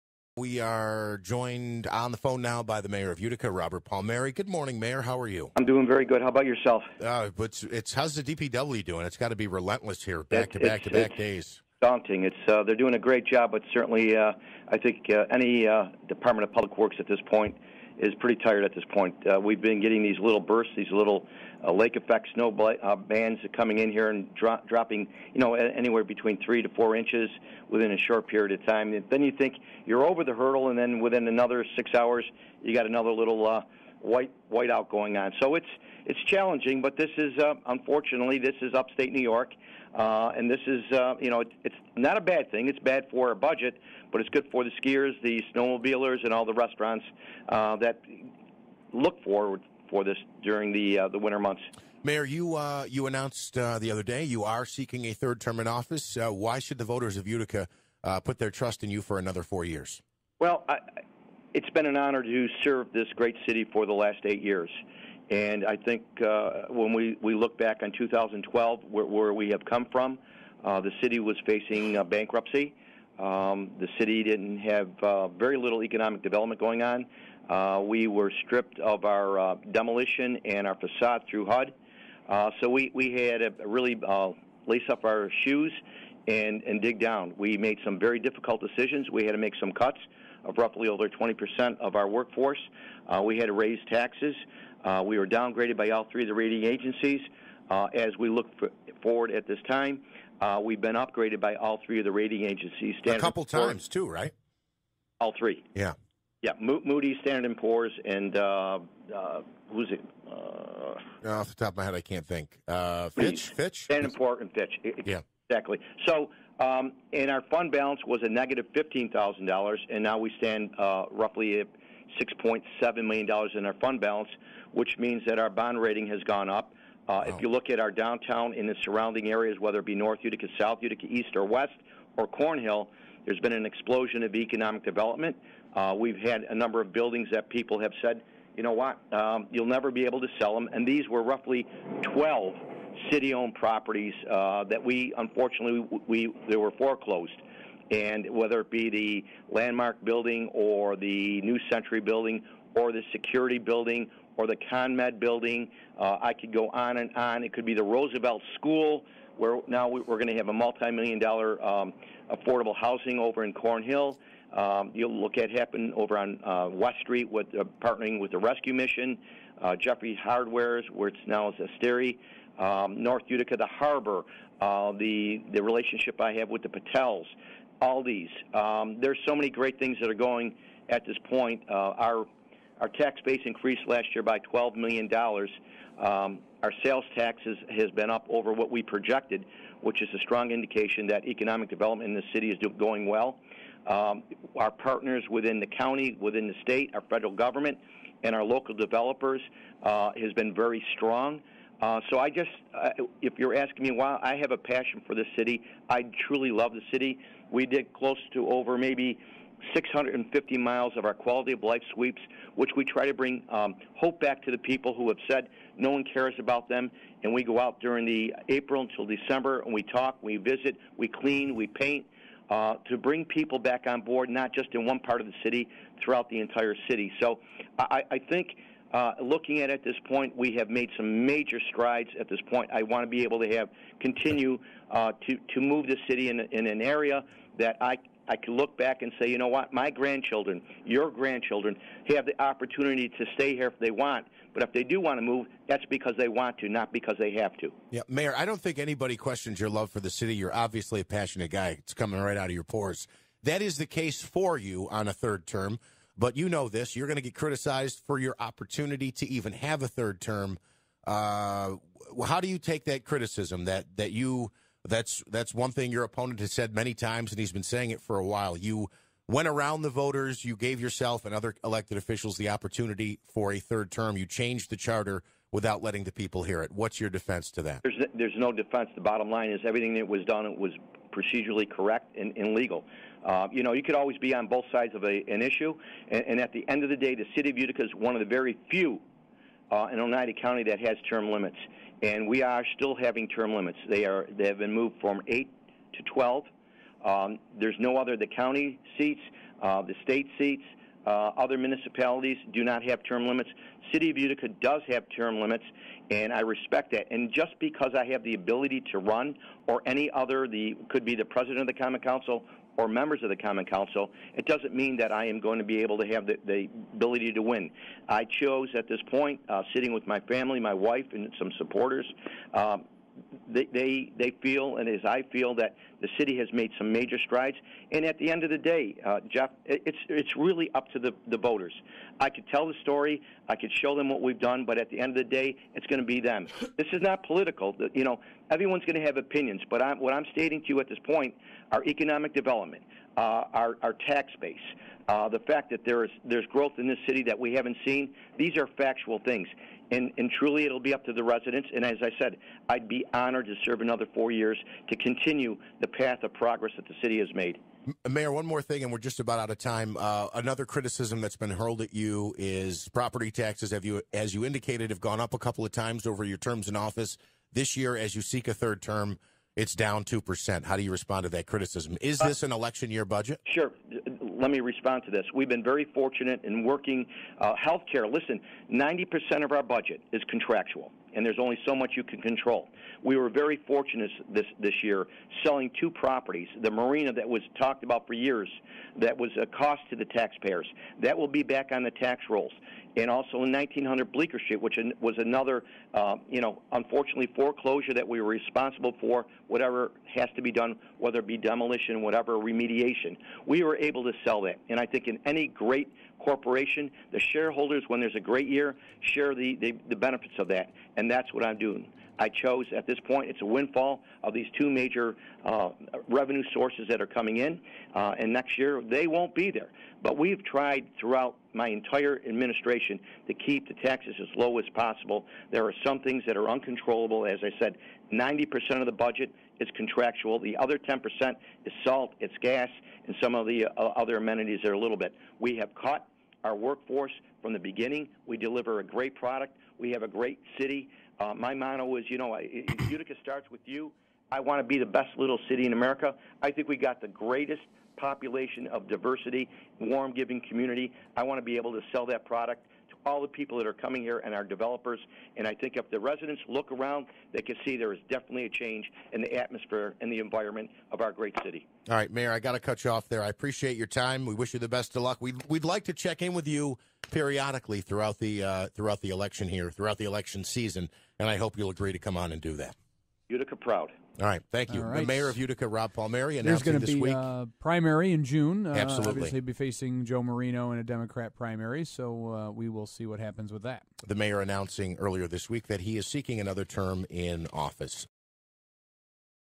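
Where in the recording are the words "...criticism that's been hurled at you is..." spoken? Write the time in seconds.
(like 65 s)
360 s.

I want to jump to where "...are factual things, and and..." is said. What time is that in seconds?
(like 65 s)
348 s.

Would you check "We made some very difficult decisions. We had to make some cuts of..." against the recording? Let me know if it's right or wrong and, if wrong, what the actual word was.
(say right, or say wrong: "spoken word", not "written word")
right.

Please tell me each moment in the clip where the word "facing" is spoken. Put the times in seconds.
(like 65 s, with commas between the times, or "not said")
71 s, 479 s.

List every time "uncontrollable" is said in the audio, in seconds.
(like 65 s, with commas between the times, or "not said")
426 s.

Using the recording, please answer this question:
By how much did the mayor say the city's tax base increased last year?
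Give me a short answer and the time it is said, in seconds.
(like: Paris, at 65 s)
$12 million, at 184 s.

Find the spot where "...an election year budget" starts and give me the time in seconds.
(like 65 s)
372 s.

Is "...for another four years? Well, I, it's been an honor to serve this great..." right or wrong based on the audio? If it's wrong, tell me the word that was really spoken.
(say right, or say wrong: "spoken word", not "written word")
right.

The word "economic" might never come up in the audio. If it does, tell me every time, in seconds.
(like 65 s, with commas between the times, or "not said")
75 s, 134 s, 191 s, 341 s.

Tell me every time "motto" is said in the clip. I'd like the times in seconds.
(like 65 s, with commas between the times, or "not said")
441 s.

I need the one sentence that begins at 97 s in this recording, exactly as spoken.
Uh, as we look for, forward at this time, uh, we've been upgraded by all three of the rating agencies.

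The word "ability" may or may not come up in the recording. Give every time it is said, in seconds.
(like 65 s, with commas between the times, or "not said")
308 s, 316 s.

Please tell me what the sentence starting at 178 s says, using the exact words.
Um, there's so many great things that are going at this point.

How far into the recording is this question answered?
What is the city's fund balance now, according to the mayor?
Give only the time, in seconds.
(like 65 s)
122 s.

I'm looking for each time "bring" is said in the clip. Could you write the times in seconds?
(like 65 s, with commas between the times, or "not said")
213 s, 222 s.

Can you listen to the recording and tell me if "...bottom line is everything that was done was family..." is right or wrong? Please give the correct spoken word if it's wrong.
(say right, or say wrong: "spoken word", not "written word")
wrong: "procedurally", not "family".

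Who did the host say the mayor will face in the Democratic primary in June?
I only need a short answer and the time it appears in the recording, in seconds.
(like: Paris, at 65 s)
Joe Marino, at 480 s.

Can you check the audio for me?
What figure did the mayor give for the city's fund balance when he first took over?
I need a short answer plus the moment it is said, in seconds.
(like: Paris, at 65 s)
$15,000, at 118 s.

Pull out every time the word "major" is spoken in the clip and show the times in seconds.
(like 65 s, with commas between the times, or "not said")
231 s, 326 s, 414 s.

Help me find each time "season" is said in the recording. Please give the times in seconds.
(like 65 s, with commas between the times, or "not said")
470 s.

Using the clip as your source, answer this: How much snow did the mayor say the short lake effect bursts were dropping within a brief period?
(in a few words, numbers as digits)
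3 to 4 inches.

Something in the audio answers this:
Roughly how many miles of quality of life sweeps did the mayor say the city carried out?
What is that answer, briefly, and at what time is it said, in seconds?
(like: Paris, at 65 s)
650 miles, at 209 s.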